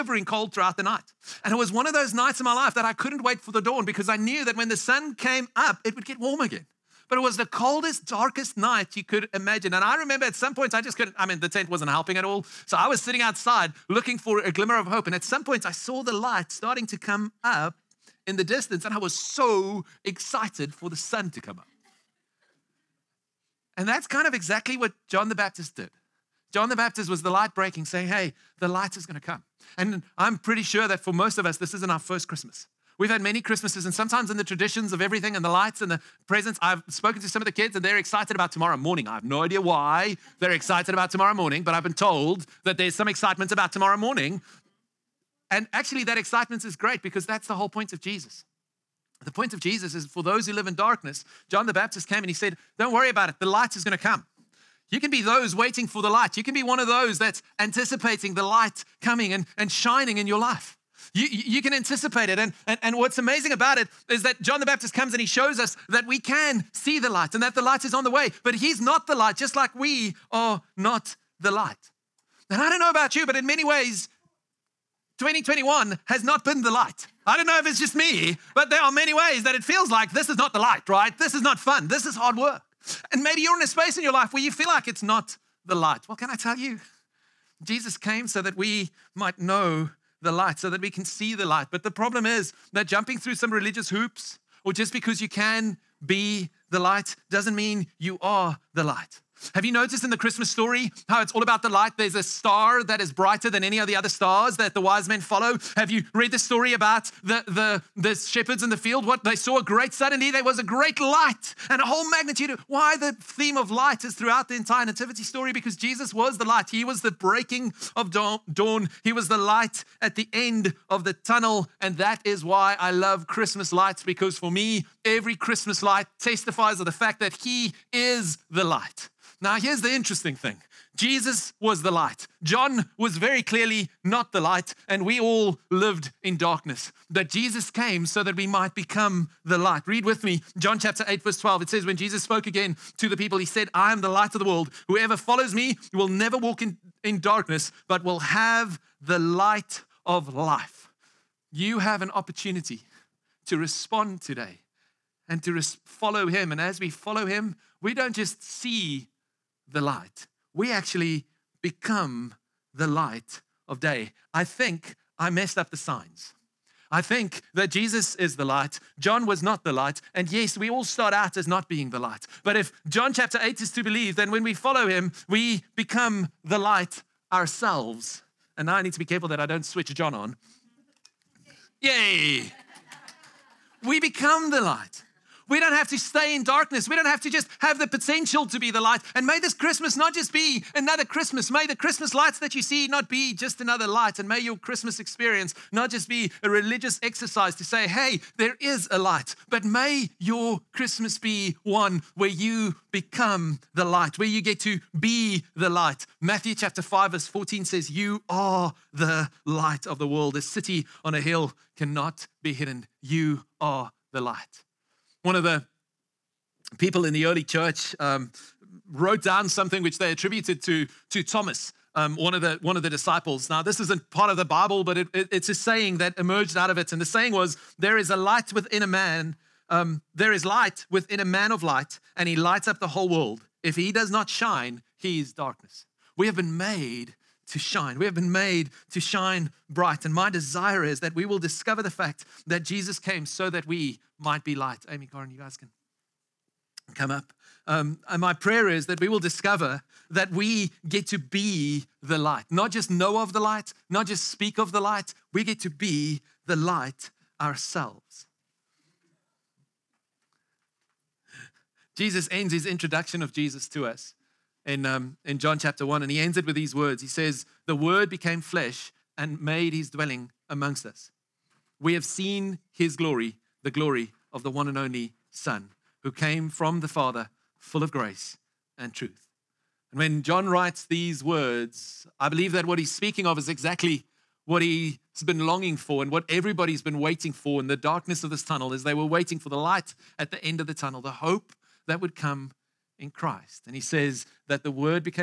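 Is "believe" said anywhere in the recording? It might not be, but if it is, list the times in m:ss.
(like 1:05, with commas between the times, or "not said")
2:53, 4:42.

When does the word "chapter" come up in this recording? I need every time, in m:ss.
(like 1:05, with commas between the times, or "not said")
2:20, 2:53, 3:26, 4:25.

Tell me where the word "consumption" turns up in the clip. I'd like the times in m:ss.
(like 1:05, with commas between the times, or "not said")
not said.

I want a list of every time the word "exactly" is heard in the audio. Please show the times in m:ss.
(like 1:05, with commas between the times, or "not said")
0:24, 4:43.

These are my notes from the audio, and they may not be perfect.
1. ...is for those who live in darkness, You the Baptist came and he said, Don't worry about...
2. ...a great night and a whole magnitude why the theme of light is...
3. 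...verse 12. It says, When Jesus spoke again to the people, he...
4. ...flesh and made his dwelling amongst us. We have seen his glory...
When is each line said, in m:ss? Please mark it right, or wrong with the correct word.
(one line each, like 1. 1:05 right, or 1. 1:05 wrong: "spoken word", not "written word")
1. 0:49 wrong: "John", not "You"
2. 1:50 wrong: "light", not "night"
3. 2:21 right
4. 4:28 right.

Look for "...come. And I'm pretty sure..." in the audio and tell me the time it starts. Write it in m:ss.
0:29.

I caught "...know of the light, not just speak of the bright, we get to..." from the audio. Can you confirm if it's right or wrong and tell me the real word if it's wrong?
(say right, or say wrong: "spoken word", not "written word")
wrong: "light", not "bright".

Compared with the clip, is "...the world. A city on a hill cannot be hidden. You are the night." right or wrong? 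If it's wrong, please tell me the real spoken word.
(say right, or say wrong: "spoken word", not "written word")
wrong: "light", not "night".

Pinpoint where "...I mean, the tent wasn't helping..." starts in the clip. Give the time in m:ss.
0:11.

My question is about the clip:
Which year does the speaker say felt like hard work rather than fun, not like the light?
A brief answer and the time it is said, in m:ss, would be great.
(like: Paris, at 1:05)
2021, at 1:15.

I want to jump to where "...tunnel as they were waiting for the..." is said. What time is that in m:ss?
4:48.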